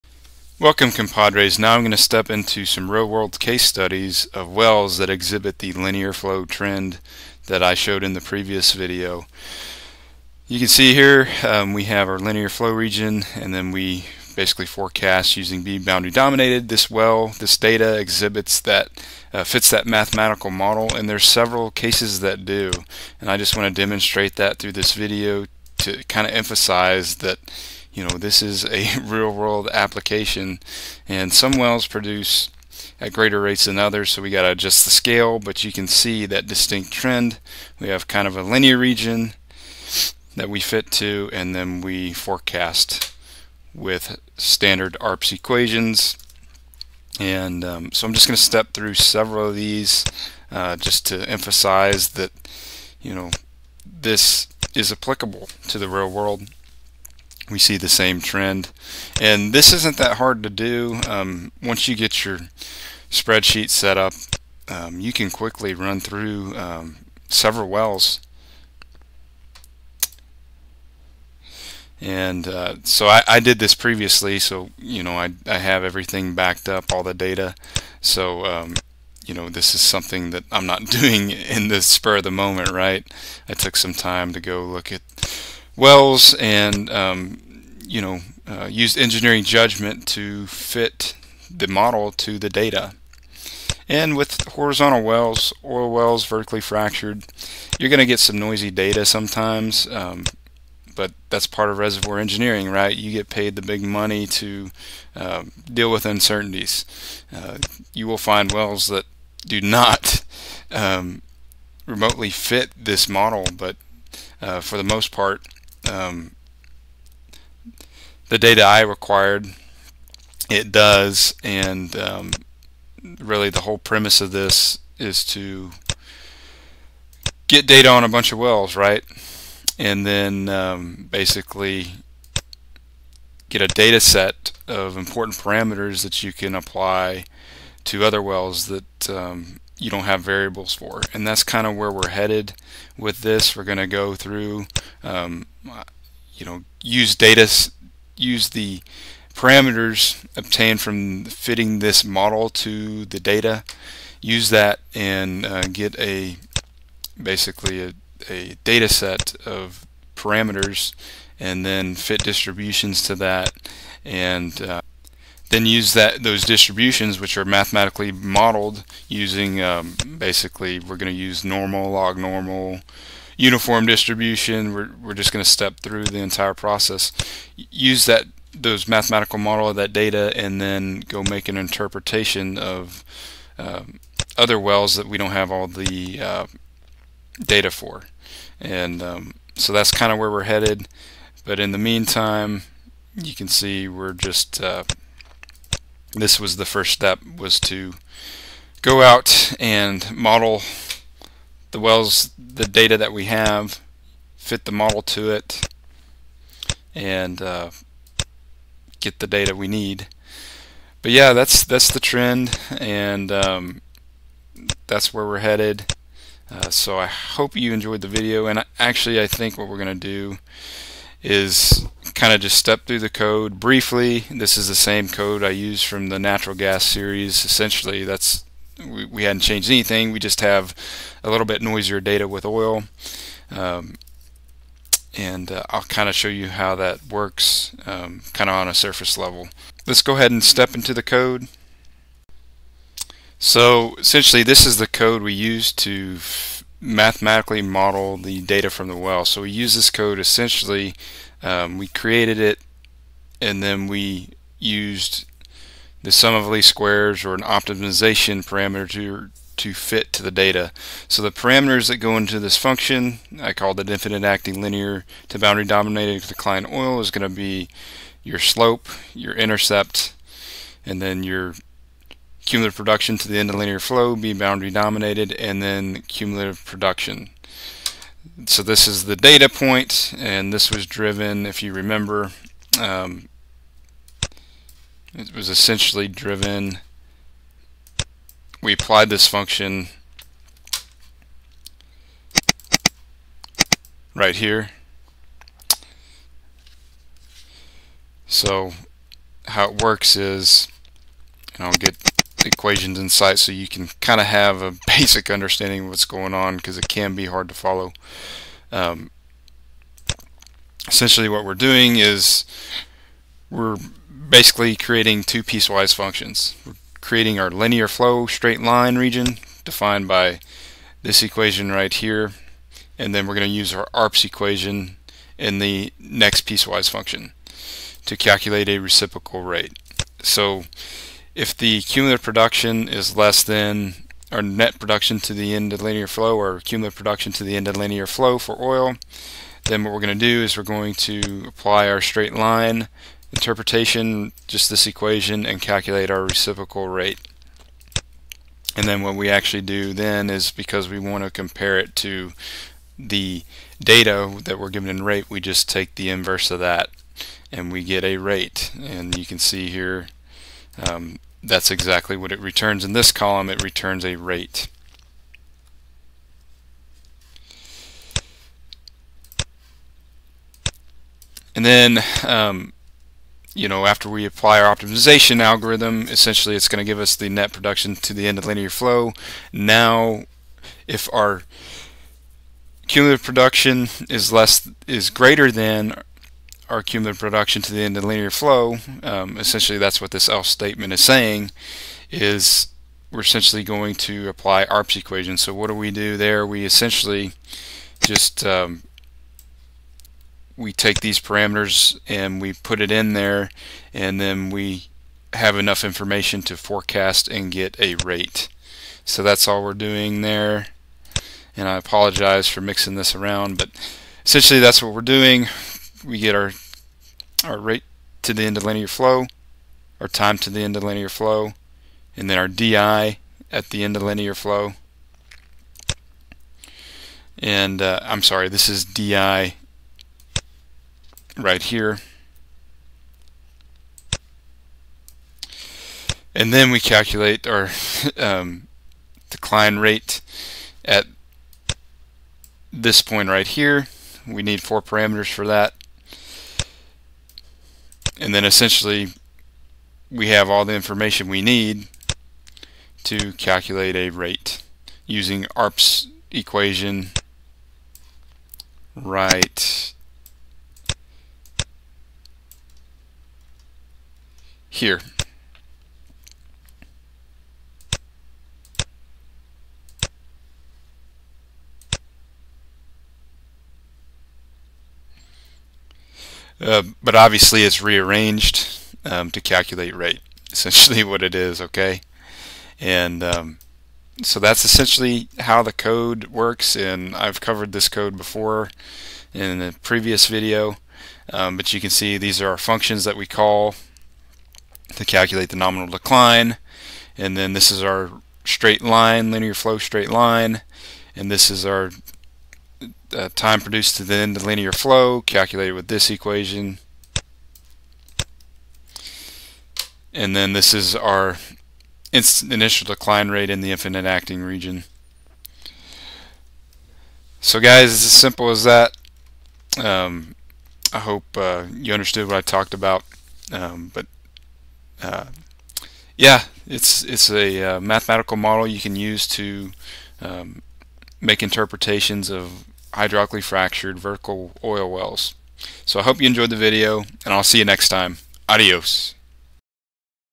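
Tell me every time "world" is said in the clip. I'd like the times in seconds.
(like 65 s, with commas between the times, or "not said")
3 s, 29 s, 56 s.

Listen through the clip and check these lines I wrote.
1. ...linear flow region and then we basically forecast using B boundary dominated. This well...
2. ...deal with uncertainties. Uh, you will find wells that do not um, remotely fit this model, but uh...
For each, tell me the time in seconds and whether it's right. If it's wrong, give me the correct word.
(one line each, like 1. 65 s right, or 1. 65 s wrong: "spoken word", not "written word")
1. 12 s right
2. 105 s right.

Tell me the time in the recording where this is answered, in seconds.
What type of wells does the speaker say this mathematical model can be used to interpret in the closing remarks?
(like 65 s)
532 s.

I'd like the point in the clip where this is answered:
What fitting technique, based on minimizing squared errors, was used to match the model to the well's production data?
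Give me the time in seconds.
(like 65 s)
256 s.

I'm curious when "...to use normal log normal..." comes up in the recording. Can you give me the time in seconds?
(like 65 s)
171 s.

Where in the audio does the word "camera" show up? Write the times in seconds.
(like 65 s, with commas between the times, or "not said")
not said.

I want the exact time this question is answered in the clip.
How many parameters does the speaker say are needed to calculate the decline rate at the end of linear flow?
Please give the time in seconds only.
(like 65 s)
444 s.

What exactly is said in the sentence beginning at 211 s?
But yeah, that's that's the trend, and um, that's where we're headed.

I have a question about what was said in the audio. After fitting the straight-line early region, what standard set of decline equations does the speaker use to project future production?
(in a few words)
ARPS equations.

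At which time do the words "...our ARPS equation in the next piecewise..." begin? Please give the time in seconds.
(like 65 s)
323 s.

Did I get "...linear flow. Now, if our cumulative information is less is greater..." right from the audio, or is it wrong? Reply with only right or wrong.
wrong.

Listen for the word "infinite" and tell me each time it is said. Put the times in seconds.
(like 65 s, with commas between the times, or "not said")
263 s, 513 s.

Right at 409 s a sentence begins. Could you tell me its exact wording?
So that's all we're doing there.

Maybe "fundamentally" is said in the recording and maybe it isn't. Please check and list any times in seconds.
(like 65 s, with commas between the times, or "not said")
not said.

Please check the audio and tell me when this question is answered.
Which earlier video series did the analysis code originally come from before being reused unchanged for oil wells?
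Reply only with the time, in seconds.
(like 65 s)
226 s.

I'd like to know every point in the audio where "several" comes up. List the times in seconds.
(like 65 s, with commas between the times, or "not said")
21 s, 48 s, 67 s.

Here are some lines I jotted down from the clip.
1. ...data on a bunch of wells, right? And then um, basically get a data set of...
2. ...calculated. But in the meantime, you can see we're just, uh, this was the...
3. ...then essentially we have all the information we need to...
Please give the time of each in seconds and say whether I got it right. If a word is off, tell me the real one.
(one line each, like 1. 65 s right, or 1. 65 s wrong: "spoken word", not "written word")
1. 127 s right
2. 190 s wrong: "headed", not "calculated"
3. 448 s right.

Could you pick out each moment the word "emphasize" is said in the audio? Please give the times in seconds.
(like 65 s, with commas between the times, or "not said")
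26 s, 51 s.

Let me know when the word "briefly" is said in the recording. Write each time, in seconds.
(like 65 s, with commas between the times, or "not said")
223 s.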